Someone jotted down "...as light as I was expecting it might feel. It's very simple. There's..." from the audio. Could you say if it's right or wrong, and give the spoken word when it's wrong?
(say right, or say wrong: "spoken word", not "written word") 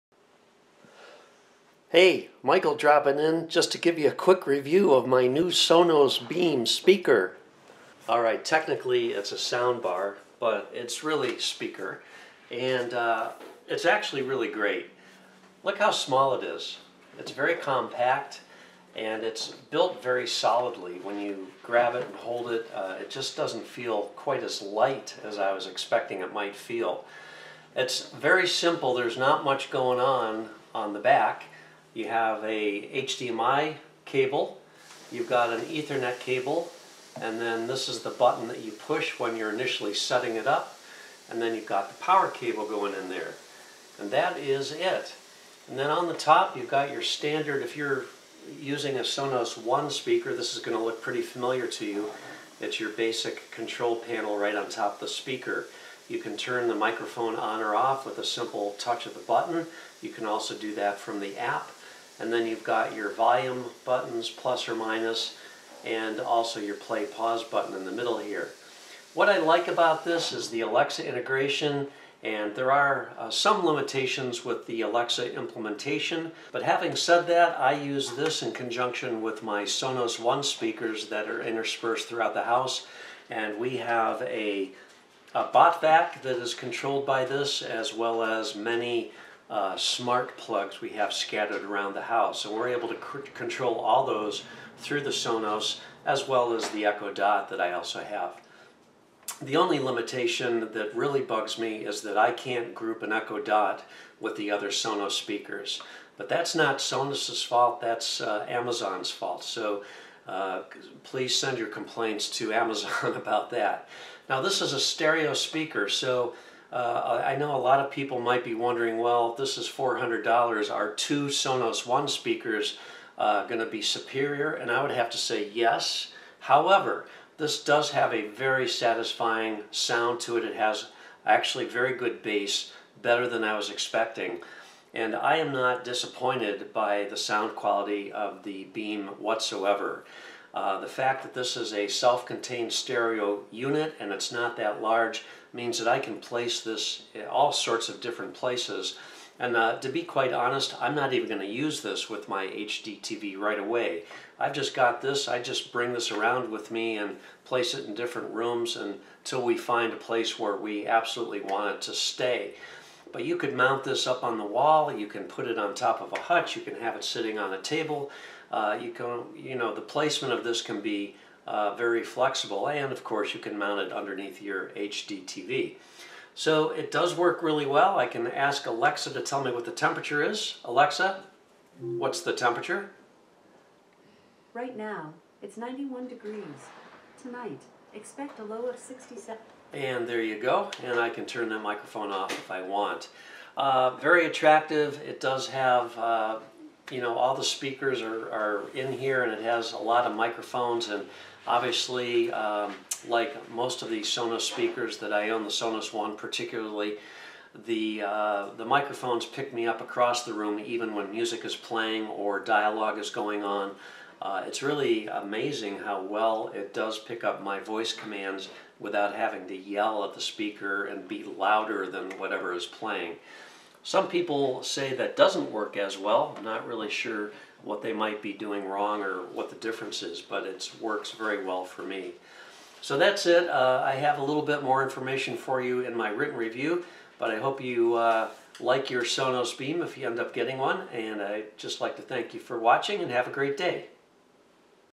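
right.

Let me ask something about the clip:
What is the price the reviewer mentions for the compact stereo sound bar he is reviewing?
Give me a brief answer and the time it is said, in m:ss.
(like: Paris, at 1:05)
$400, at 1:59.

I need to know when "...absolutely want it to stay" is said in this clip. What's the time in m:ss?
2:40.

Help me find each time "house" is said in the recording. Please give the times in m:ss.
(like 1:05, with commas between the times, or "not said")
1:22, 1:32.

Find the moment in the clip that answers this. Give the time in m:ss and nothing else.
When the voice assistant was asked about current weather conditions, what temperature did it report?
3:05.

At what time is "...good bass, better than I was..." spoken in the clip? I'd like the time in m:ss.
2:11.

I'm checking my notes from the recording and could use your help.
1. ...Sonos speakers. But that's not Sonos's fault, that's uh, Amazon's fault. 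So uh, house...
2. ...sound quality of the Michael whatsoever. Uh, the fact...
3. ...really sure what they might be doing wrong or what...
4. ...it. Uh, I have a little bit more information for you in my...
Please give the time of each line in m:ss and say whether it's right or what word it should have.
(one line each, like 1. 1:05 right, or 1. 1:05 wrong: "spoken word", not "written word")
1. 1:44 wrong: "please", not "house"
2. 2:17 wrong: "Beam", not "Michael"
3. 3:46 right
4. 3:53 right.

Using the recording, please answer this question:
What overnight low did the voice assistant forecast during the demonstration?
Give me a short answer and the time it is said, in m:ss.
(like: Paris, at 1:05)
67, at 3:08.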